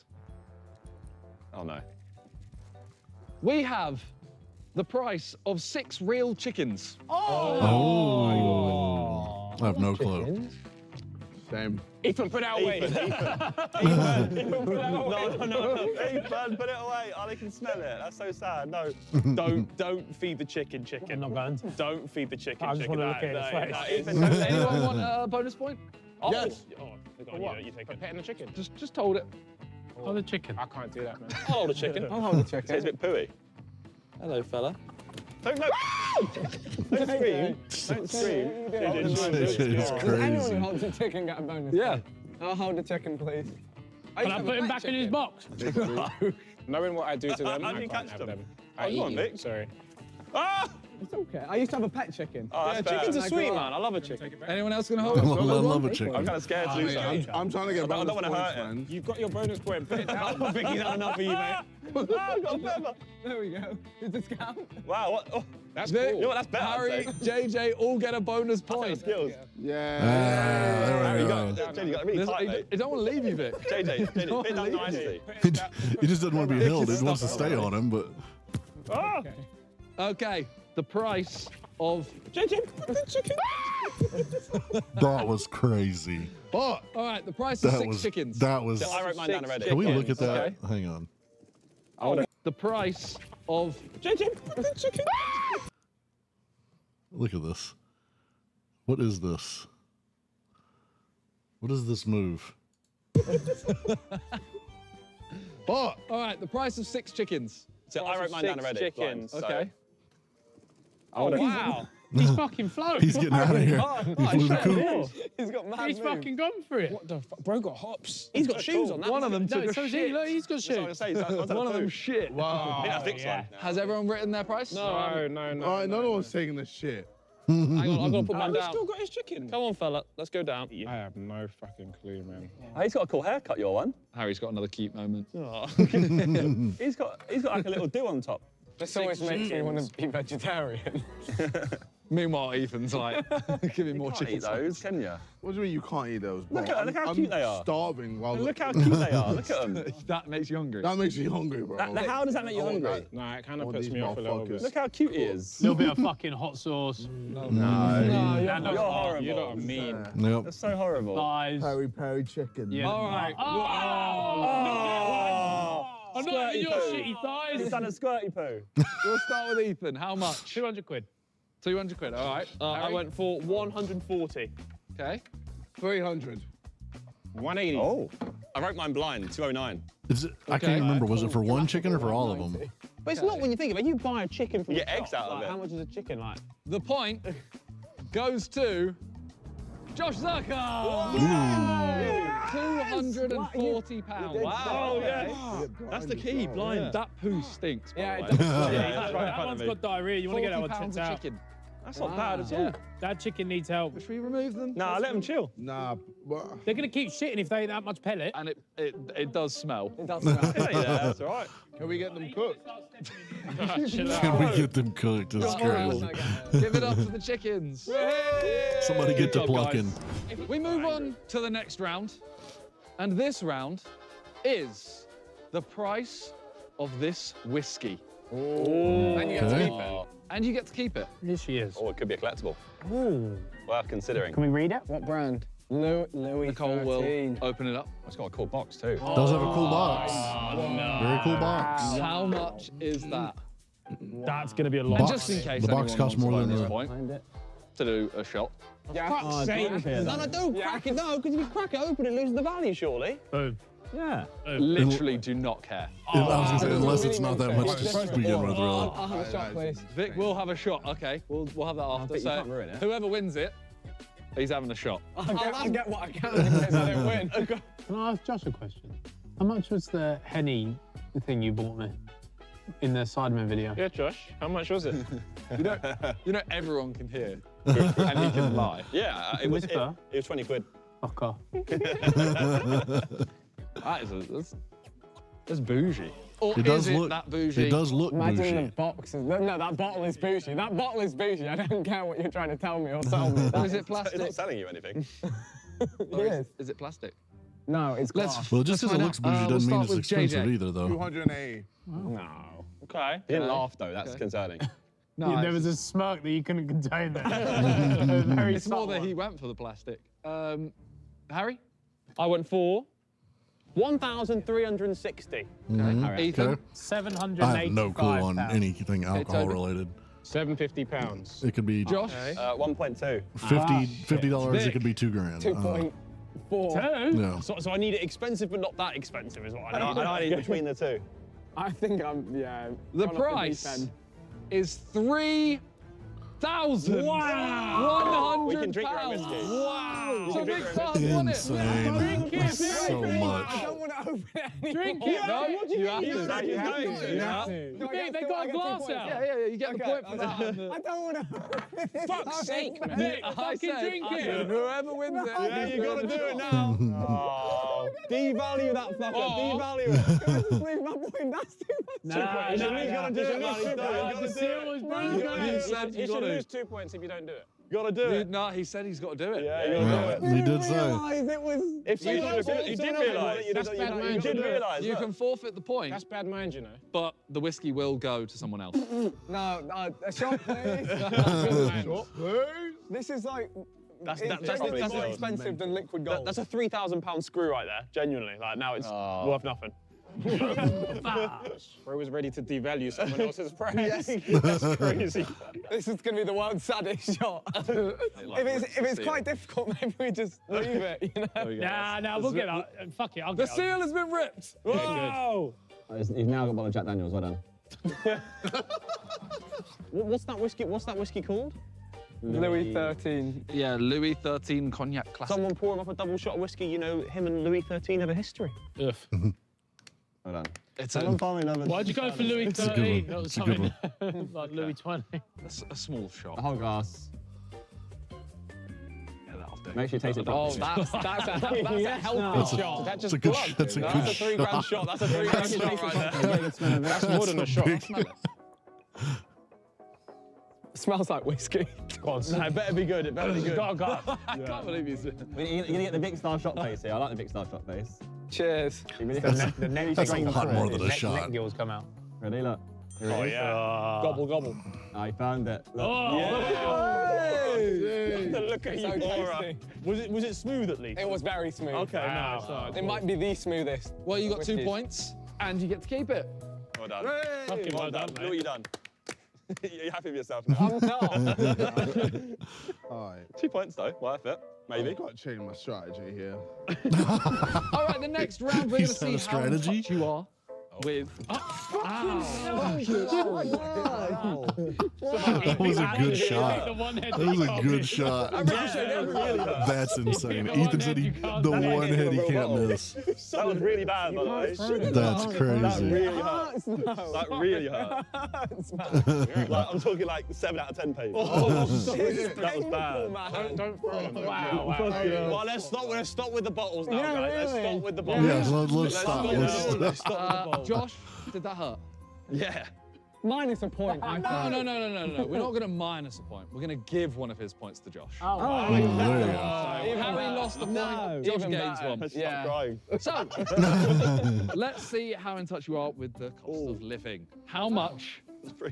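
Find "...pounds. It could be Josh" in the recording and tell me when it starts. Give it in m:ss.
5:20.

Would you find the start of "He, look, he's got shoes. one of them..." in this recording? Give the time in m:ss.
2:00.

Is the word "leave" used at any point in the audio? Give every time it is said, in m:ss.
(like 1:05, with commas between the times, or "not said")
1:13, 6:00, 6:40.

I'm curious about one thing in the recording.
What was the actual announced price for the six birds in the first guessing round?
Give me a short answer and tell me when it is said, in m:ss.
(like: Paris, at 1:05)
240 pounds, at 3:12.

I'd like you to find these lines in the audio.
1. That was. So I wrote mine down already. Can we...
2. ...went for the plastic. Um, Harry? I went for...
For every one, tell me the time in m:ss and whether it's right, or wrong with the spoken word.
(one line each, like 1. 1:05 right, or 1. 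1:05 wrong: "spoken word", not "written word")
1. 1:28 right
2. 5:09 right.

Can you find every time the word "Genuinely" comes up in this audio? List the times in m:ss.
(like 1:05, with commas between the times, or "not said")
6:27.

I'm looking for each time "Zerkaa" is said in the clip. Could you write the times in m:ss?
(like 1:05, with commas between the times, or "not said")
3:10.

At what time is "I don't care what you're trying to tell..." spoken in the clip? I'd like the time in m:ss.
4:51.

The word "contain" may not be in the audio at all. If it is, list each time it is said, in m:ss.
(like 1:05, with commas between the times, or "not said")
5:06.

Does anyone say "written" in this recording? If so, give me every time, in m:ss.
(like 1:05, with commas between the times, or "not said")
2:04.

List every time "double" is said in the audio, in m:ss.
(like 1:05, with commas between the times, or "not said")
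6:55.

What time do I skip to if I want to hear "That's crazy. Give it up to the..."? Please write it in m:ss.
3:35.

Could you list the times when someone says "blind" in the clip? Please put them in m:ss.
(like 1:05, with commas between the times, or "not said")
2:58, 3:16.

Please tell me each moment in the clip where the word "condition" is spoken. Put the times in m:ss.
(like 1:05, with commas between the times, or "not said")
not said.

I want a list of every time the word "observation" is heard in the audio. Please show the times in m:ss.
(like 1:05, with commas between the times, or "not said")
not said.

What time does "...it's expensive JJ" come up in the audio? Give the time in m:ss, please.
4:59.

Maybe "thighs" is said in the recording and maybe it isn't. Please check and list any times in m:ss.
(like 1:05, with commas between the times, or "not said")
2:41, 2:47.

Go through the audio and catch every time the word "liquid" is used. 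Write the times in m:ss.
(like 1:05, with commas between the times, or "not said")
6:25.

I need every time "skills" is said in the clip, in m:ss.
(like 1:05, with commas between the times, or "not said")
1:08.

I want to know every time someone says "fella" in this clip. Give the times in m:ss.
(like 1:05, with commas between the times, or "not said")
0:34, 2:09.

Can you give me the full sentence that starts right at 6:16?
but the whiskey will go to someone else.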